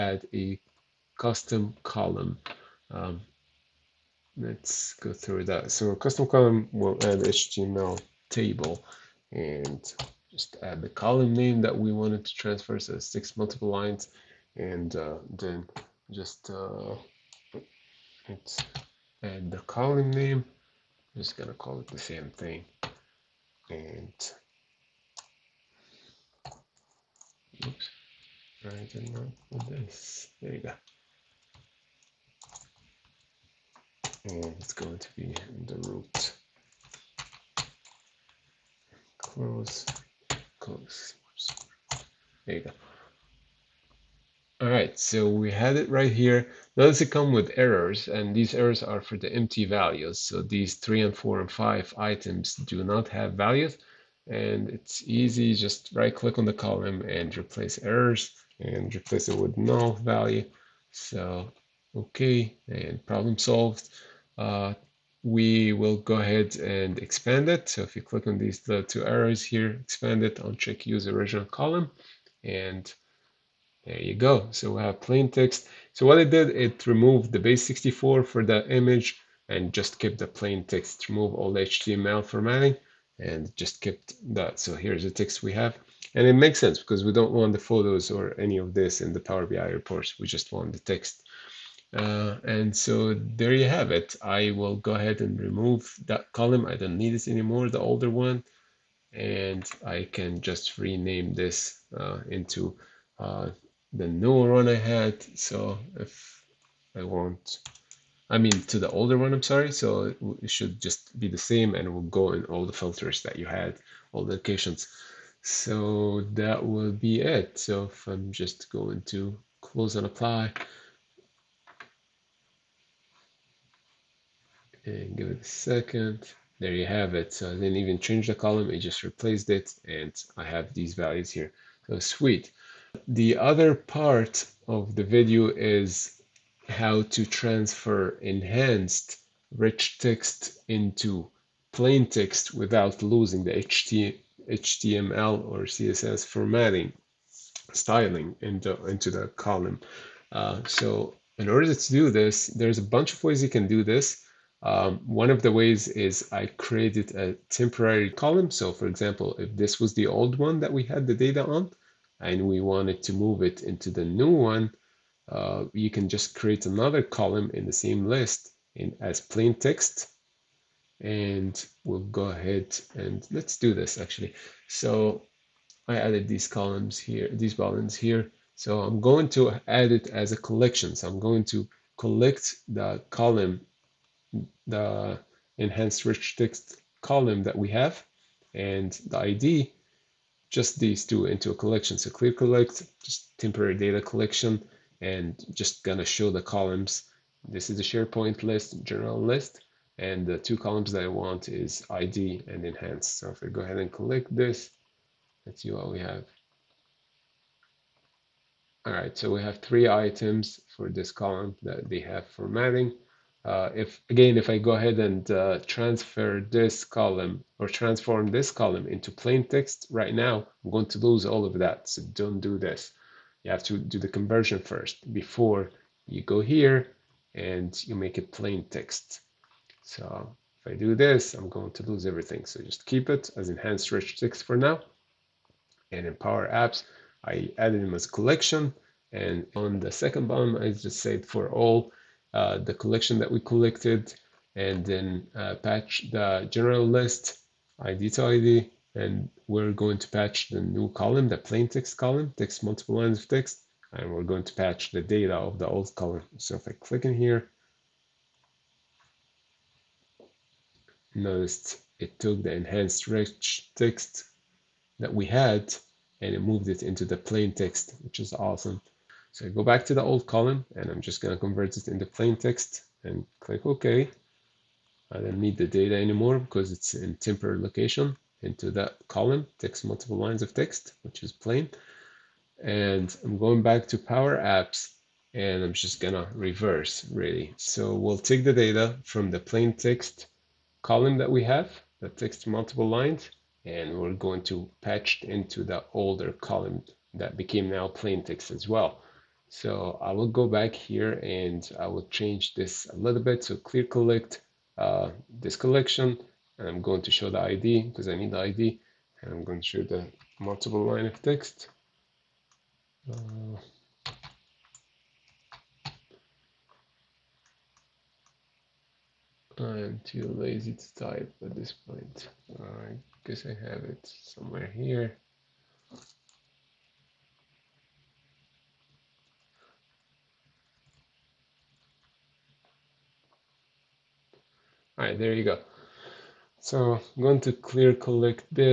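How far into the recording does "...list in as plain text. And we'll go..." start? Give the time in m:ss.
2:48.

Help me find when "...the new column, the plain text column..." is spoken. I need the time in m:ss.
4:10.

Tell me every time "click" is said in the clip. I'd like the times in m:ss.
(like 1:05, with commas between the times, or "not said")
0:56, 1:08, 4:16, 4:33.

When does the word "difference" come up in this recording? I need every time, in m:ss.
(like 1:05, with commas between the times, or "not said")
not said.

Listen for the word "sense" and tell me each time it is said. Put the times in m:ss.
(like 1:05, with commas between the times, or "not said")
1:26.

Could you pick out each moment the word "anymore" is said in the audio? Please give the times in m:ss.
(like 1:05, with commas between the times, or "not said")
1:37, 4:35.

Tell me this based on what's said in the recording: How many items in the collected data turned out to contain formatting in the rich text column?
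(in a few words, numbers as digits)
3.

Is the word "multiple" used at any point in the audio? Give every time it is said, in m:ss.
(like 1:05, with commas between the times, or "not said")
0:13, 4:12, 4:39, 4:52, 5:10.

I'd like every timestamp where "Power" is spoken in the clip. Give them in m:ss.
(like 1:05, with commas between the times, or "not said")
1:29, 3:56, 4:43.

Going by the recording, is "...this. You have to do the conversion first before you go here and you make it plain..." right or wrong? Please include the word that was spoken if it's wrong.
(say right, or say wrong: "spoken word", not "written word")
right.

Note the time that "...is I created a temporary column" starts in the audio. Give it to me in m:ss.
2:35.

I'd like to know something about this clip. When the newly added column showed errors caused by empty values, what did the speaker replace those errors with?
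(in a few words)
no value.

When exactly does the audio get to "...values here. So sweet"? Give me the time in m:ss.
2:10.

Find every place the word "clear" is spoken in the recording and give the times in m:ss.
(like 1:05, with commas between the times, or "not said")
3:12, 5:03, 5:37.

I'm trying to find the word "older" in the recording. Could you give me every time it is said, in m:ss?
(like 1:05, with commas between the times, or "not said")
1:37, 1:48, 4:55.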